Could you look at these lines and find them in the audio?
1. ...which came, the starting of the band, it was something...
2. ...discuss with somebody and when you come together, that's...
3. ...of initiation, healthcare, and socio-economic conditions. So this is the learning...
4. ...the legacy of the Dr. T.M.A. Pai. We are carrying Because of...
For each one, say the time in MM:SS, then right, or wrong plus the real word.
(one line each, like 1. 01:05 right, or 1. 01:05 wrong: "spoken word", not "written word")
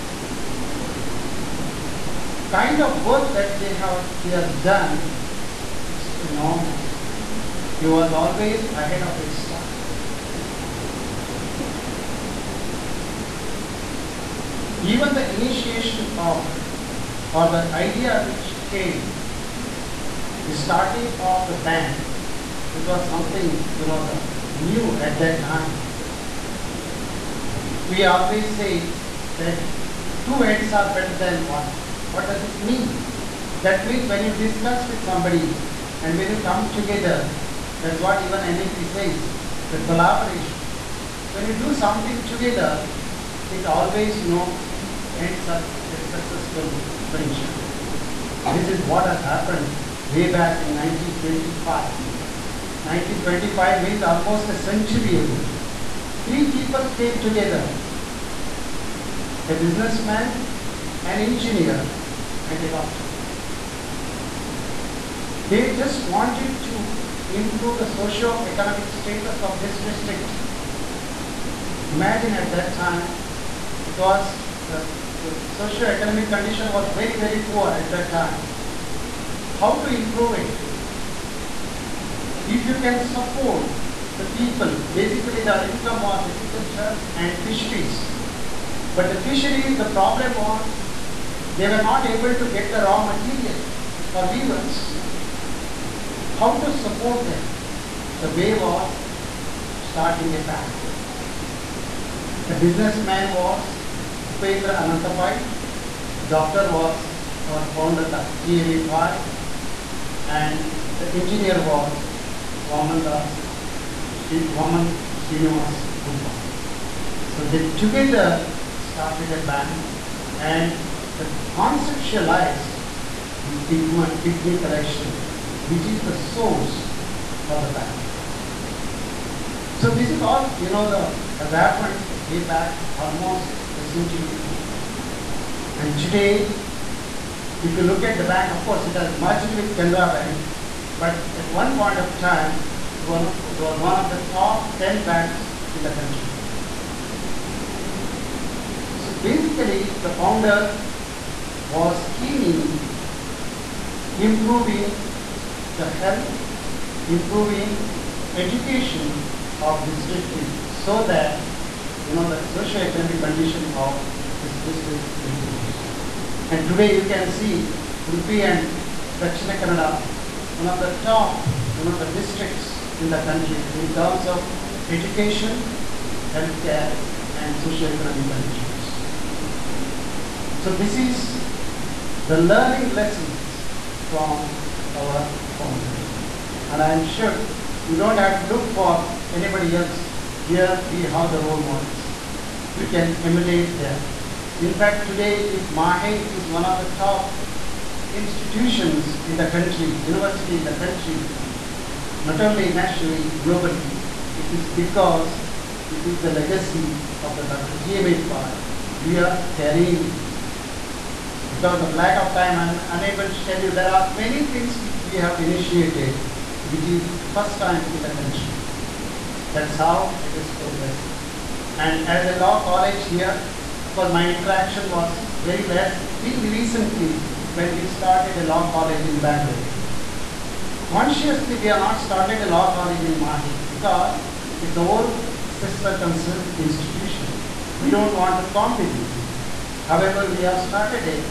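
1. 00:18 right
2. 00:34 right
3. 02:54 wrong: "education", not "initiation"
4. 03:26 right.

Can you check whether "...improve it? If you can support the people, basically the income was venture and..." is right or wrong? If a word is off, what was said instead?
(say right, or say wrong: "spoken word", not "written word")
wrong: "agriculture", not "venture".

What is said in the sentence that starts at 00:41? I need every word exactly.
When you do something together, it always, you know, ends up a successful venture.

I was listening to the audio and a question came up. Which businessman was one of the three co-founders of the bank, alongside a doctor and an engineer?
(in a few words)
Upendra Anantapai.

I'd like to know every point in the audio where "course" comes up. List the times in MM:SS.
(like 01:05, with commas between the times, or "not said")
02:18, 03:43.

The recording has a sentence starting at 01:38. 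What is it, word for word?
The way was starting a bank.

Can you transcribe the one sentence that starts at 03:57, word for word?
We don't want to compete with it.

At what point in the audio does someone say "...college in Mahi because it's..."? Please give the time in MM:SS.
03:52.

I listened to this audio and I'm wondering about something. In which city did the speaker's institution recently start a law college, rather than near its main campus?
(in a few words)
Bangalore.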